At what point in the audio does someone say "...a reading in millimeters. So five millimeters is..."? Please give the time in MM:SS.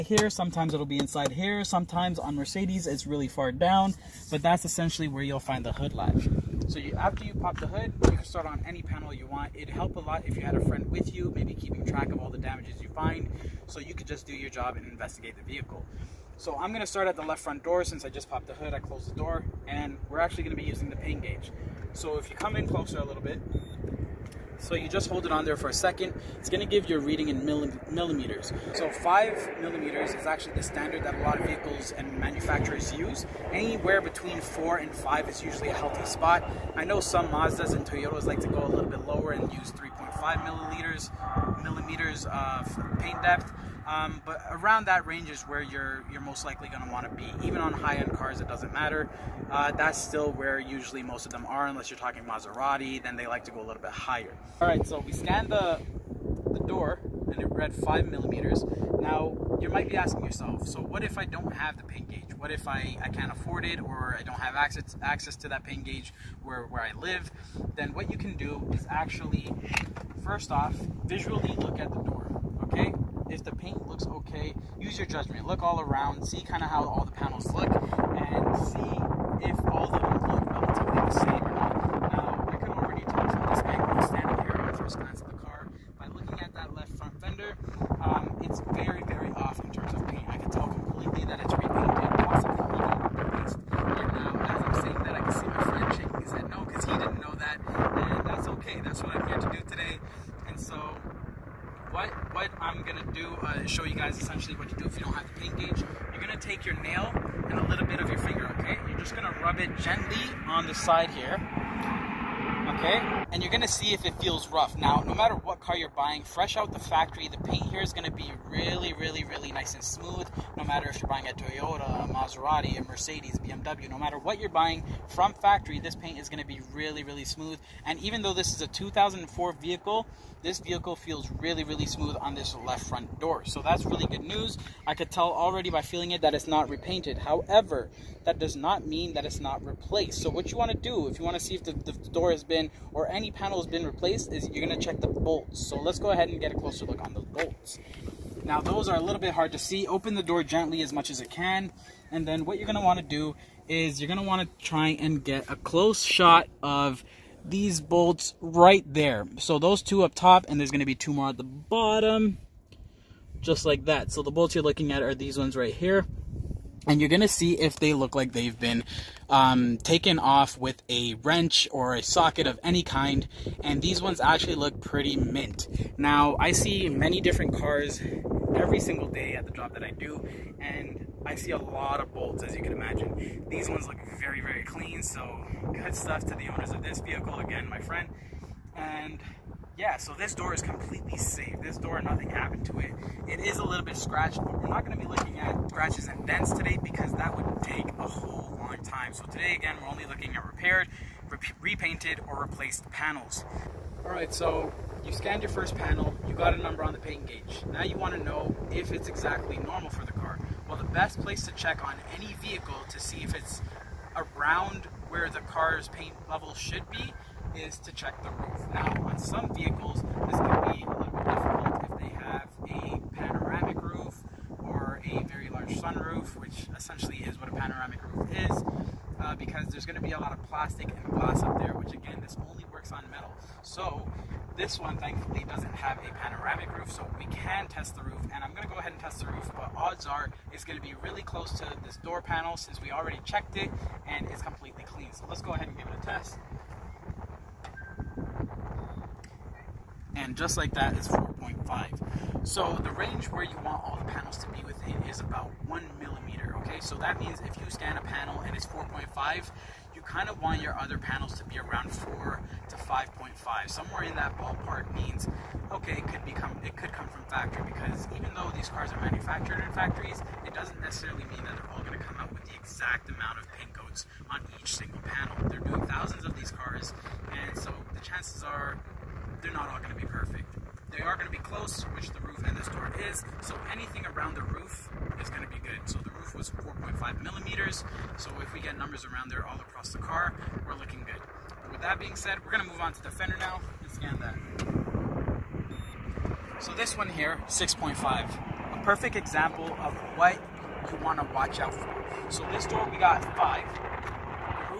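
00:26.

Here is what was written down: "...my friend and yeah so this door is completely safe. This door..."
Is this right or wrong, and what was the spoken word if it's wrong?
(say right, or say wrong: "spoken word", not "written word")
right.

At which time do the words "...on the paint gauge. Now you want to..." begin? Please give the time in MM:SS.
03:26.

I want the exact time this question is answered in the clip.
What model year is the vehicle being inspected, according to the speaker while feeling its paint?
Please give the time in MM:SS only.
02:08.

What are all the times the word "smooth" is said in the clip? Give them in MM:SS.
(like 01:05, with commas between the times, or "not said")
01:59, 02:07, 02:11.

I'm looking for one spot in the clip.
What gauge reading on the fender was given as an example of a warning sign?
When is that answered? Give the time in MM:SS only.
04:57.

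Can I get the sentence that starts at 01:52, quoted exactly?
Okay, and you're gonna see if it feels rough.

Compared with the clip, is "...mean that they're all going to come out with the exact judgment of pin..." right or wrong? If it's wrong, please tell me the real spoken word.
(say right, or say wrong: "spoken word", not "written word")
wrong: "amount", not "judgment".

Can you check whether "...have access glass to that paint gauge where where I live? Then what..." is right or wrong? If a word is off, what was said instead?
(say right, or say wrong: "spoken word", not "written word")
wrong: "access", not "glass".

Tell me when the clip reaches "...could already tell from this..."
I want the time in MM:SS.
01:22.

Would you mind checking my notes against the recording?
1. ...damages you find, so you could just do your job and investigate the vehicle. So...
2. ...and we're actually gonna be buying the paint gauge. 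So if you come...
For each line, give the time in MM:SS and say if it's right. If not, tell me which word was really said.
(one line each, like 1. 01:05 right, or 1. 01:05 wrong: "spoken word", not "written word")
1. 00:12 right
2. 00:19 wrong: "using", not "buying".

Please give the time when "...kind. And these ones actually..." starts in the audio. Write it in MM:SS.
02:52.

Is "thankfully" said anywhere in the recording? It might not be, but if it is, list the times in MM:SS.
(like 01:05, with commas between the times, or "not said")
03:54.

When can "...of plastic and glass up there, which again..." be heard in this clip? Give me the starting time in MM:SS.
03:50.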